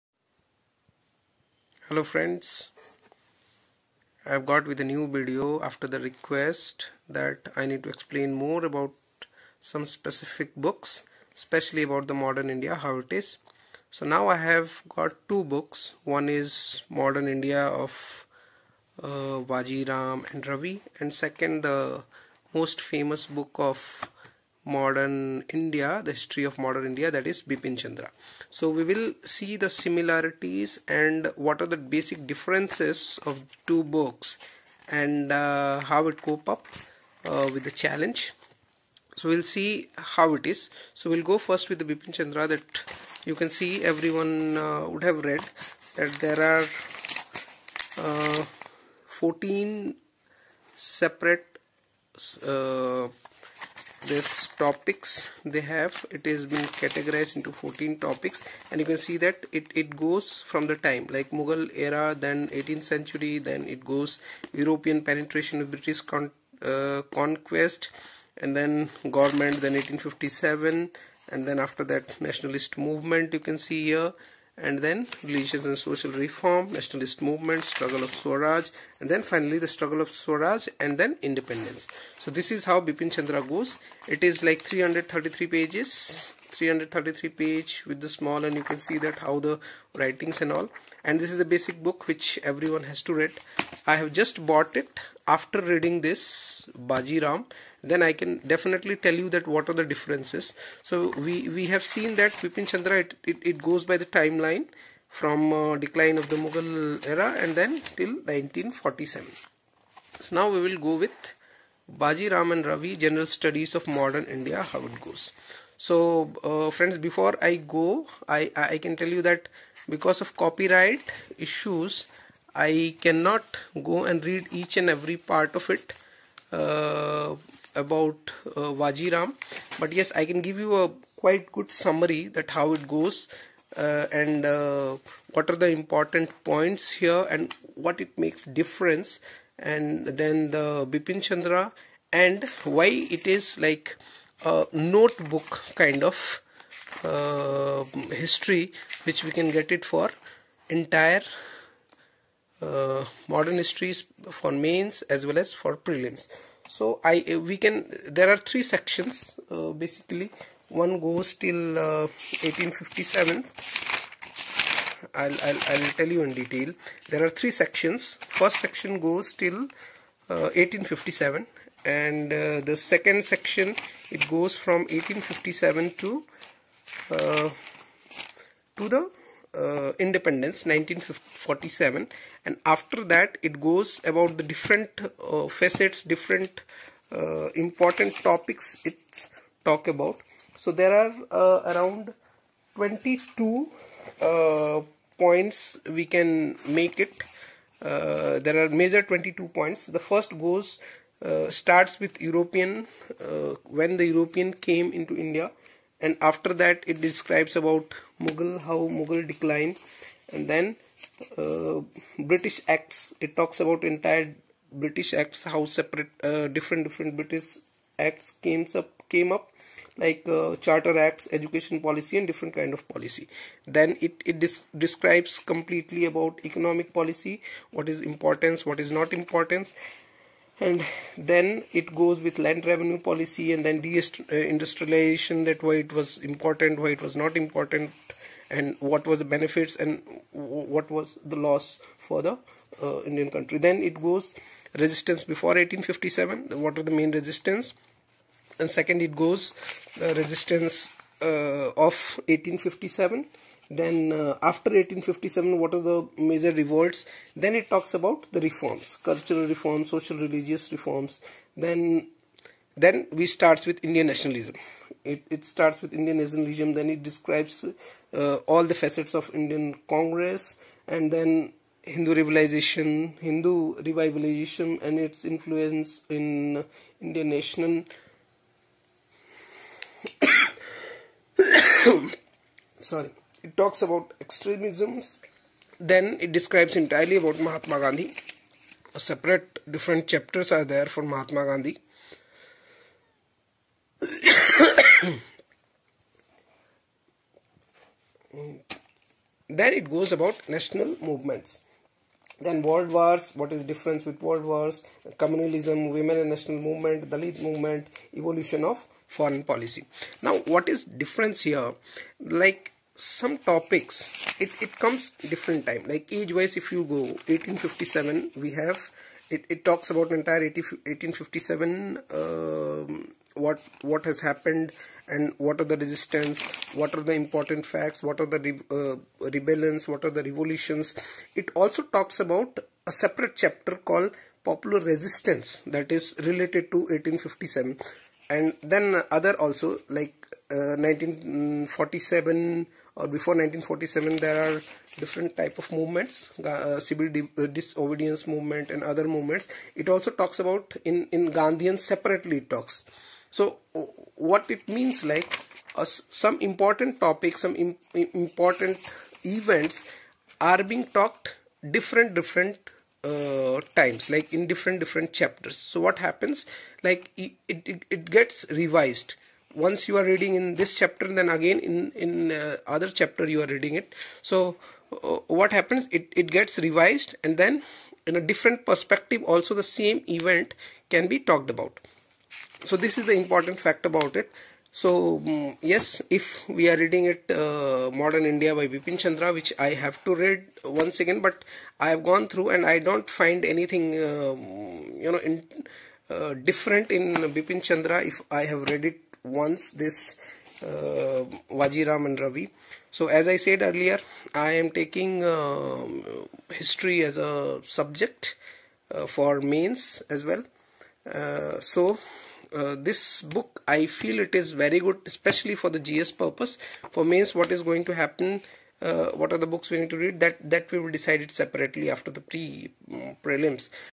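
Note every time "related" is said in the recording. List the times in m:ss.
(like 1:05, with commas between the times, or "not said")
5:36.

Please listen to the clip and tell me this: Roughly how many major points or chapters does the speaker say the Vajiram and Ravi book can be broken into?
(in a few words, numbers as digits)
22.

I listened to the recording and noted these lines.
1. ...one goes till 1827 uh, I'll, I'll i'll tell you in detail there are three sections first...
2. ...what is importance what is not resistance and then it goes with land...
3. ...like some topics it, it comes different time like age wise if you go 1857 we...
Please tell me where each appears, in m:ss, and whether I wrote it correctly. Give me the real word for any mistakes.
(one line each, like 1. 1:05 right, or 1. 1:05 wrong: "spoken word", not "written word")
1. 2:40 wrong: "1857", not "1827"
2. 3:47 wrong: "importance", not "resistance"
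3. 5:12 right.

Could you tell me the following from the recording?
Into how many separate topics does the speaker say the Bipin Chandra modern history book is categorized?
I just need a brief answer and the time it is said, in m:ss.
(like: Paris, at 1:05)
14, at 0:49.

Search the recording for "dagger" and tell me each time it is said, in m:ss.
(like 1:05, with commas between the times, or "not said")
not said.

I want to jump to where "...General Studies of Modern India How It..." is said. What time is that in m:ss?
1:52.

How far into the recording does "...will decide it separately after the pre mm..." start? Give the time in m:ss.
7:00.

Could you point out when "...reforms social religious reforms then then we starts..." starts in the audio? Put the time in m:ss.
4:19.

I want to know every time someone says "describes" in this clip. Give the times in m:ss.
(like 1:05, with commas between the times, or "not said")
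3:27, 3:44, 4:27, 4:46.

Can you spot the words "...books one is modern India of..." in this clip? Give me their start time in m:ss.
0:15.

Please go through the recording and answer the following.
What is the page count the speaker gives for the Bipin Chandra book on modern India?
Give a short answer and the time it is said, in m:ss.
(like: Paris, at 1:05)
333, at 1:24.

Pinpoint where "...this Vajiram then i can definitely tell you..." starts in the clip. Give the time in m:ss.
1:36.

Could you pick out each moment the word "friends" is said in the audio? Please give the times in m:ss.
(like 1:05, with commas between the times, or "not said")
0:02, 1:56.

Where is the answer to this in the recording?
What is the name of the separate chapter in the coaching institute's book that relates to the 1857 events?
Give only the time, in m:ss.
5:34.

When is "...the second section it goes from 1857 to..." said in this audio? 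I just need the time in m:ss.
2:52.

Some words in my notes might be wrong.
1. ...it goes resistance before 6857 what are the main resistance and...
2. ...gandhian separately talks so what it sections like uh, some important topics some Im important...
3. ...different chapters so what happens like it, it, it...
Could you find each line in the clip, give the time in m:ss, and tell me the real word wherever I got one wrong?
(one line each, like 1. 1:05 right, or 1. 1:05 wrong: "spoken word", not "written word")
1. 4:03 wrong: "1857", not "6857"
2. 5:51 wrong: "means", not "sections"
3. 6:04 right.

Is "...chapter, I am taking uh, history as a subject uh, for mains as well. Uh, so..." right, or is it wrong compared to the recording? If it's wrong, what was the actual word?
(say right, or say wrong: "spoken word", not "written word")
wrong: "earlier", not "chapter".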